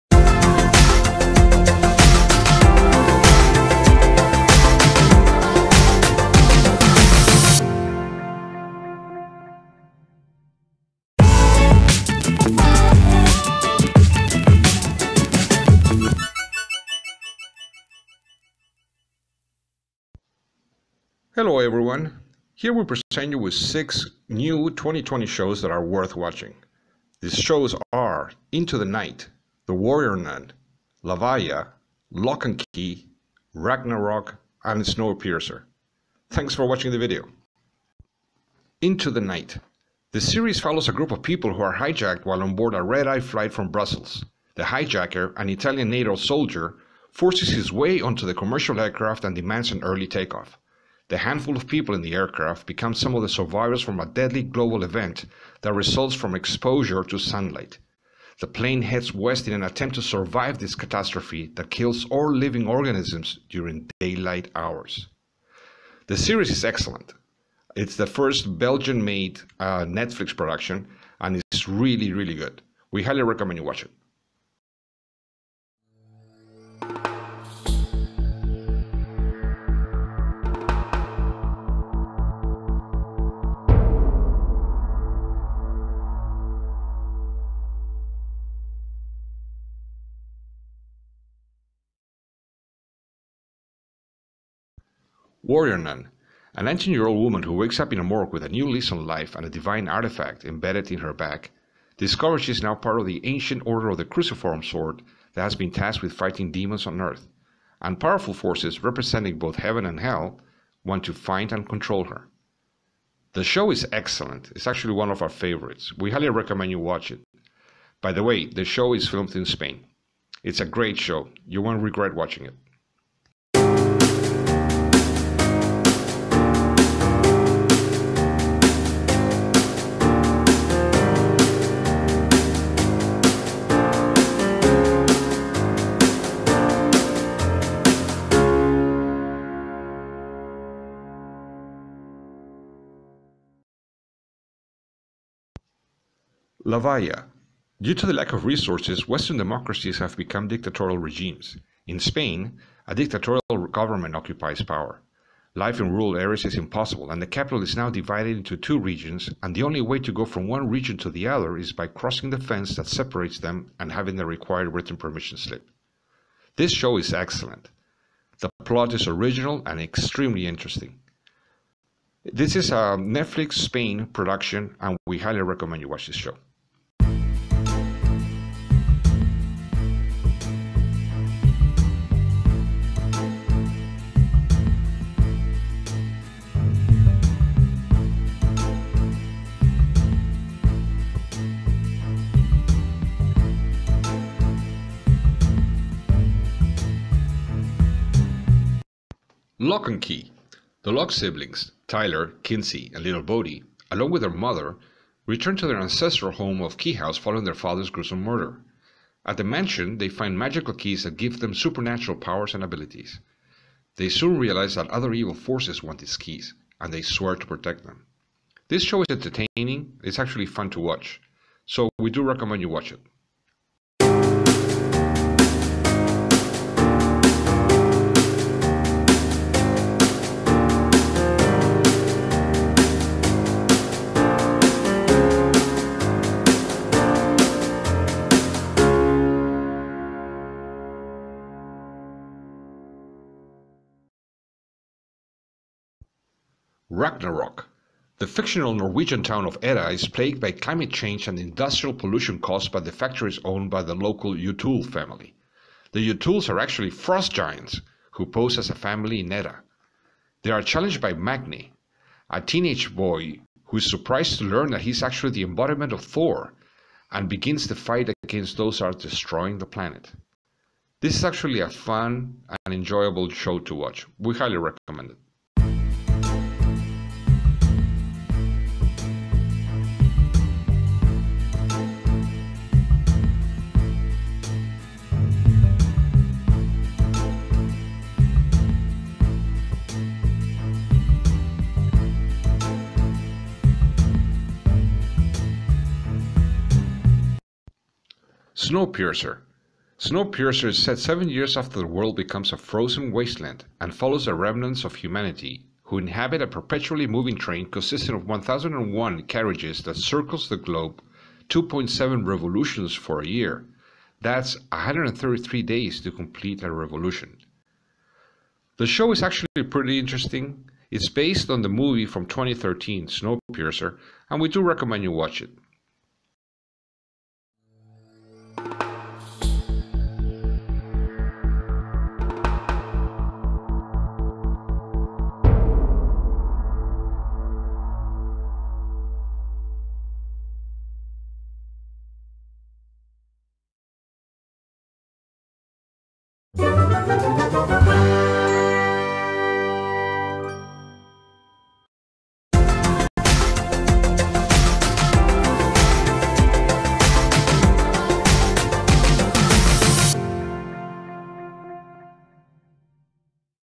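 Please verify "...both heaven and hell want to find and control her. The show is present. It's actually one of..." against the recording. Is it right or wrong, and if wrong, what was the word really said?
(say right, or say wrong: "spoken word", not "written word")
wrong: "excellent", not "present".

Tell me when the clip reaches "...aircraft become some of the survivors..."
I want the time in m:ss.
0:52.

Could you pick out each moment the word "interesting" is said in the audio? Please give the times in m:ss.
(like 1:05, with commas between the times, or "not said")
2:50, 5:19.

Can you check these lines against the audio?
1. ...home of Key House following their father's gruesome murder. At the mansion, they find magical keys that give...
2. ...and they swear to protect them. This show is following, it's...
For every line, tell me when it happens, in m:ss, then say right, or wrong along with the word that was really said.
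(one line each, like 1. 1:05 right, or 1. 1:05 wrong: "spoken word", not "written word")
1. 3:26 right
2. 3:36 wrong: "entertaining", not "following".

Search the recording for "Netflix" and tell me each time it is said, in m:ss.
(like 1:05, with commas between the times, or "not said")
1:09, 2:53.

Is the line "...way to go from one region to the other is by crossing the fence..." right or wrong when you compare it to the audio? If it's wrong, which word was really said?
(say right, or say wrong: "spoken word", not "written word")
right.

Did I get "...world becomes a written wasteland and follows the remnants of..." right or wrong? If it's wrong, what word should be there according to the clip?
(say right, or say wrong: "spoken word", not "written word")
wrong: "frozen", not "written".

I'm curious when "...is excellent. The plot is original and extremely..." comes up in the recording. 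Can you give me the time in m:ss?
2:46.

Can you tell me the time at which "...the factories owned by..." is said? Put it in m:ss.
4:12.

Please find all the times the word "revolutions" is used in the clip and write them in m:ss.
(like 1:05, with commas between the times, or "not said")
5:12, 5:16.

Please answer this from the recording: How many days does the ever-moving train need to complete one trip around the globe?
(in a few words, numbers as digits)
133 days.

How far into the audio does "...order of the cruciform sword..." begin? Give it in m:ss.
1:43.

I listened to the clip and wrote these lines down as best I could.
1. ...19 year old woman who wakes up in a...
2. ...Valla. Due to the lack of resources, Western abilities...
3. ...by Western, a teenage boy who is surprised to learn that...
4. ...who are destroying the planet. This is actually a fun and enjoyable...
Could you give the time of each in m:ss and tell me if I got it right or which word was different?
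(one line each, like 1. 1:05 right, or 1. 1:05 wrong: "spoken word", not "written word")
1. 1:36 right
2. 2:26 wrong: "democracies", not "abilities"
3. 4:20 wrong: "Magne", not "Western"
4. 4:28 right.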